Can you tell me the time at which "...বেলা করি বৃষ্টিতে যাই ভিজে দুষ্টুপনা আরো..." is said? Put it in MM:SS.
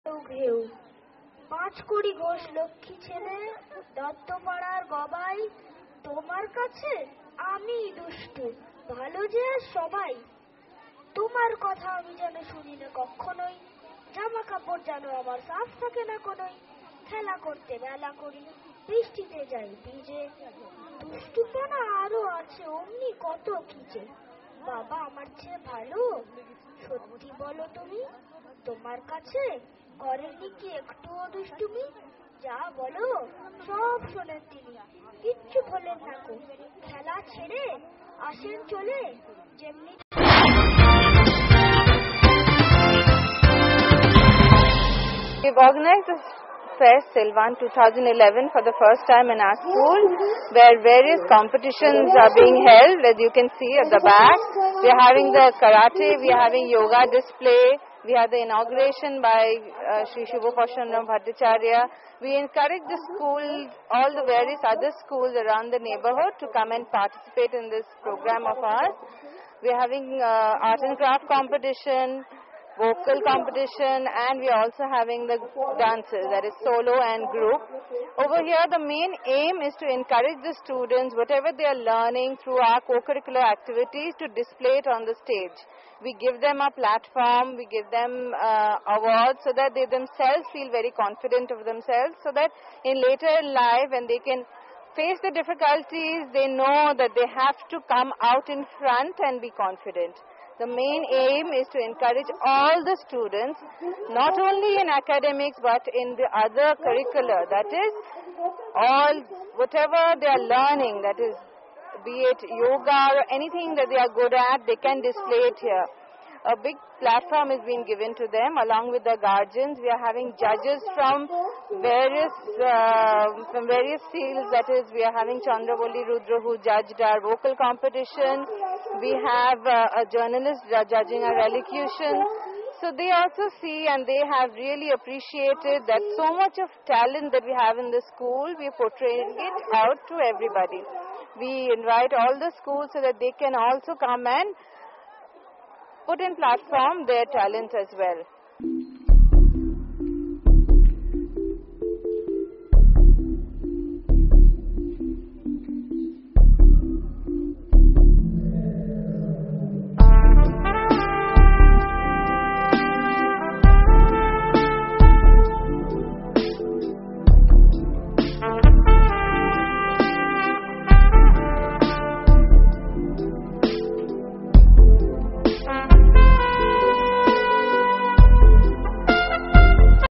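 00:17.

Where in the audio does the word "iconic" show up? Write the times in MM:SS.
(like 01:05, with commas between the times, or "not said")
not said.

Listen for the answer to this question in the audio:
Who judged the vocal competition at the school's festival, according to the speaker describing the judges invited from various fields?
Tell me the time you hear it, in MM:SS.
02:05.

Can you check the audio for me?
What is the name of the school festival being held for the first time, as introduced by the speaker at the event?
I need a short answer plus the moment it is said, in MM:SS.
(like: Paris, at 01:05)
Fest Silvan 2011, at 00:46.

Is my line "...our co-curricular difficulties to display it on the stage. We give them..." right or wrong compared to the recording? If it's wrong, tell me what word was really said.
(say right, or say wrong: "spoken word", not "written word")
wrong: "activities", not "difficulties".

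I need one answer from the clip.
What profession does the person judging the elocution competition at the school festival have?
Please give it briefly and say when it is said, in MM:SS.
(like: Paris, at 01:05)
journalist, at 02:10.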